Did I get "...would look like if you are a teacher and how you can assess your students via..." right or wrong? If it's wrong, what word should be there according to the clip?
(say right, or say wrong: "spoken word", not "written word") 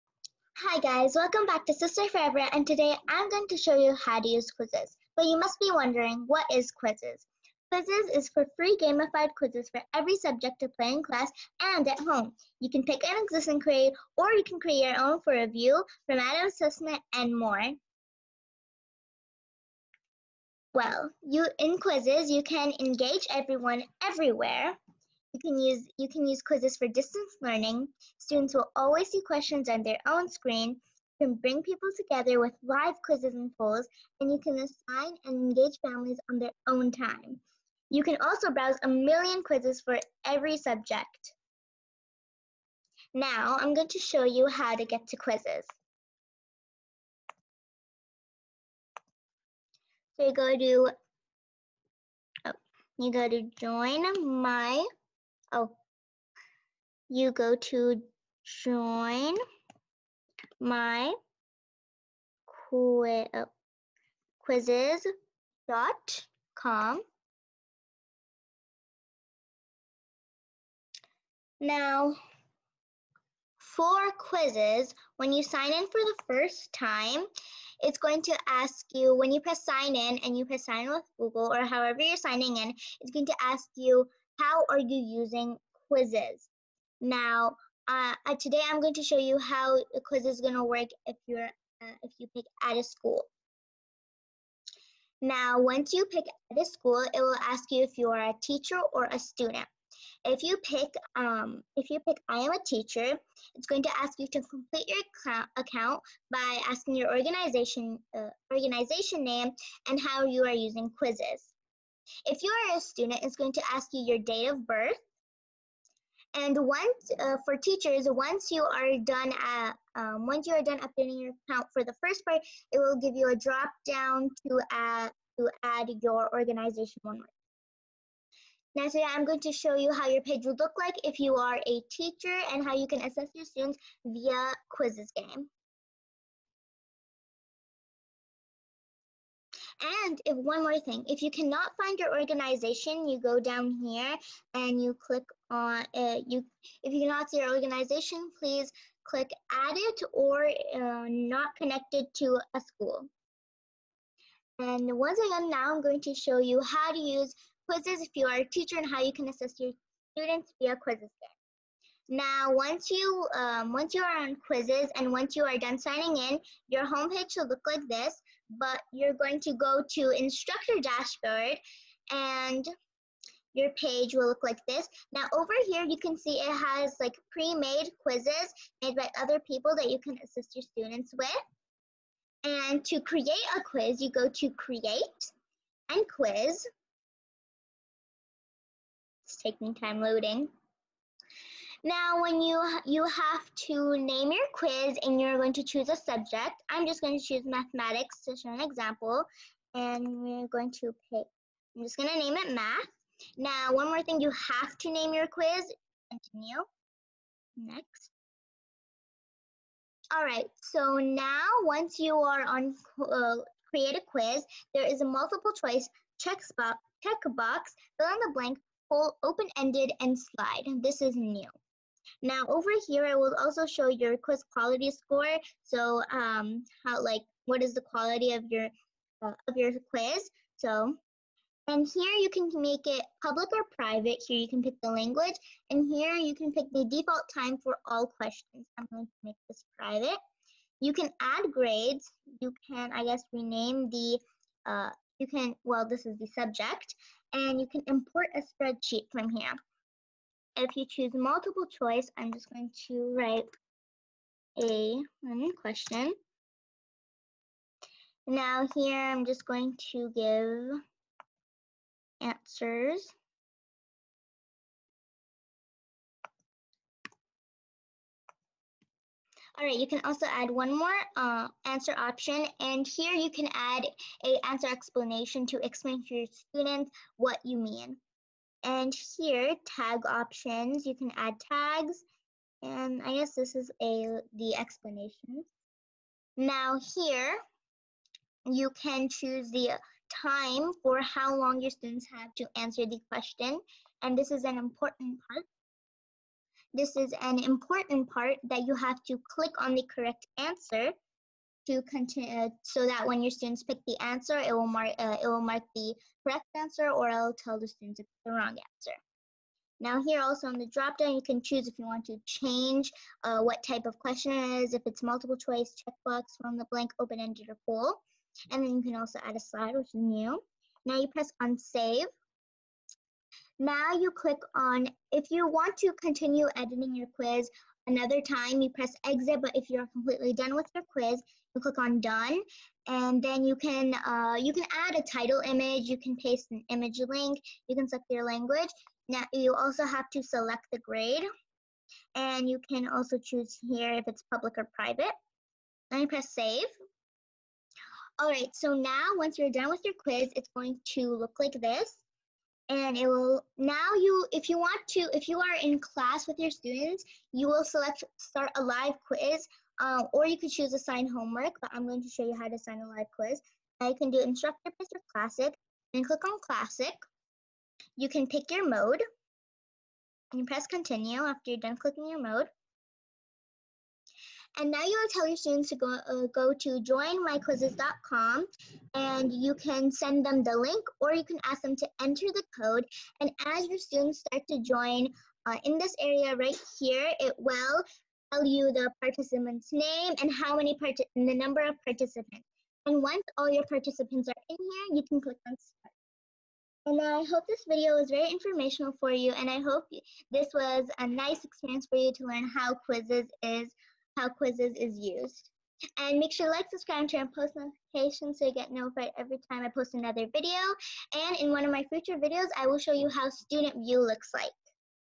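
right.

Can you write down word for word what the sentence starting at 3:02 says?
And to create a quiz, you go to create and quiz.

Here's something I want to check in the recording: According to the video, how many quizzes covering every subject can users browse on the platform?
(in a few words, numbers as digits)
a million.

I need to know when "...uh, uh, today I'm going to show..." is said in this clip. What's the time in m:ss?
1:27.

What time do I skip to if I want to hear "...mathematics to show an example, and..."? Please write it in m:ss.
3:17.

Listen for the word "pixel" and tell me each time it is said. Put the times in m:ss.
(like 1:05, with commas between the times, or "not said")
not said.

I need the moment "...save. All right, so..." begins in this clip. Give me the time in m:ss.
5:46.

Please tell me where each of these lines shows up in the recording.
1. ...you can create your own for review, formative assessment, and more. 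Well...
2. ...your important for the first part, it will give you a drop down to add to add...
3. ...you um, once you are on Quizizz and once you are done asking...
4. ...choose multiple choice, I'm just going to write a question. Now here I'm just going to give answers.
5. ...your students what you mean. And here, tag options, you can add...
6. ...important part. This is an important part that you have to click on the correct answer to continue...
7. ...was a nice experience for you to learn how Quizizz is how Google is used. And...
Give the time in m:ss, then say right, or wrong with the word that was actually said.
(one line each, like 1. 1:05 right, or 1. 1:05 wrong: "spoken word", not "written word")
1. 0:14 right
2. 2:01 wrong: "account", not "important"
3. 2:42 wrong: "signing", not "asking"
4. 4:10 right
5. 4:36 right
6. 4:54 right
7. 6:40 wrong: "Quizizz", not "Google".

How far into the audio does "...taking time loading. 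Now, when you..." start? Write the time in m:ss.
3:09.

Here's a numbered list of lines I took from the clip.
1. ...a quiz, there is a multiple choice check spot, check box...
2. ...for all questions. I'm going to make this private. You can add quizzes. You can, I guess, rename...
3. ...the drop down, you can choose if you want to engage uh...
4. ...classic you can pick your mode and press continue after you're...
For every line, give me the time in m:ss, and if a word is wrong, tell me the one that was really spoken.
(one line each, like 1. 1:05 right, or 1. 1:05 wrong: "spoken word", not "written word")
1. 3:33 right
2. 3:57 wrong: "grades", not "quizzes"
3. 5:10 wrong: "change", not "engage"
4. 6:06 right.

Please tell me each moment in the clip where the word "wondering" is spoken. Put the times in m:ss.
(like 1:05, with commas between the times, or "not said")
0:05.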